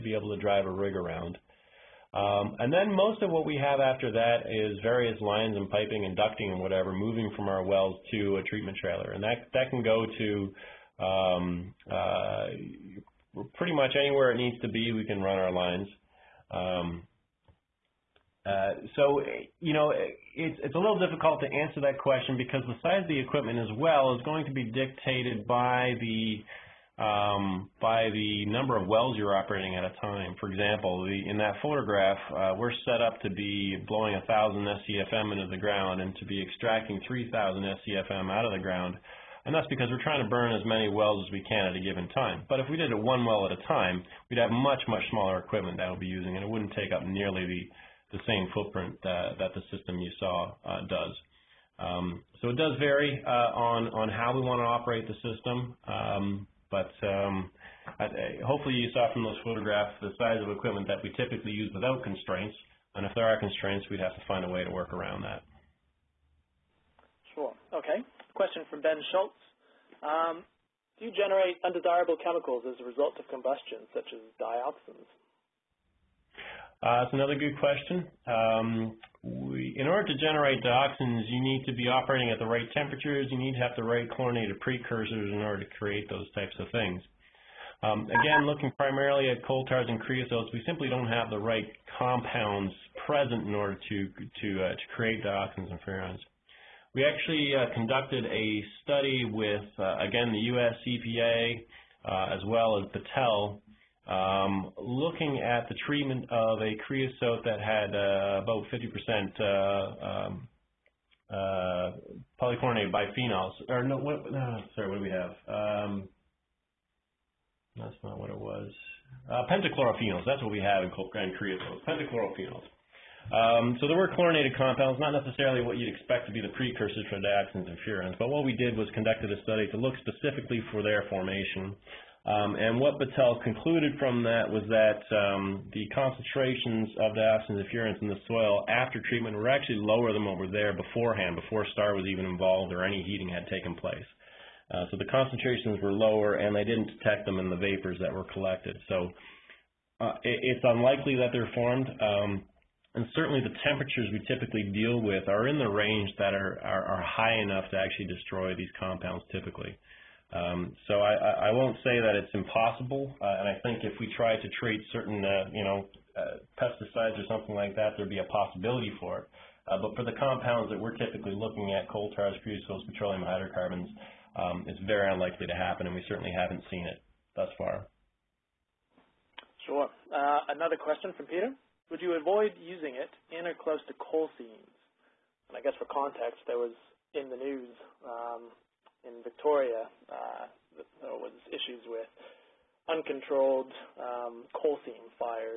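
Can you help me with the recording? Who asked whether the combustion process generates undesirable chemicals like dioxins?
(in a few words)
Ben Schultz.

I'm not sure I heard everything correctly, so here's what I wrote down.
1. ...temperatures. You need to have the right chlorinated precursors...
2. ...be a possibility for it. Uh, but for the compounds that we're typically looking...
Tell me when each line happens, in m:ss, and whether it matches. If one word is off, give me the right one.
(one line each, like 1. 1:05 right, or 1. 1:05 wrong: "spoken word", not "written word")
1. 1:22 right
2. 2:48 right.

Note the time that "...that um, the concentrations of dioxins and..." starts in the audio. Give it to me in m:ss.
2:14.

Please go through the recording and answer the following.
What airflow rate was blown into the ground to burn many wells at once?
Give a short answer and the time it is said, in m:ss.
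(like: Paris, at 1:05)
1,000 SCFM, at 0:34.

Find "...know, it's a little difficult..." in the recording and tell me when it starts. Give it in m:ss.
0:19.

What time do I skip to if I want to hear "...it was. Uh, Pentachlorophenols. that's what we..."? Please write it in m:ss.
1:58.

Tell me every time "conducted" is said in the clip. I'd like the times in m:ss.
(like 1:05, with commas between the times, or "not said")
1:37, 2:08.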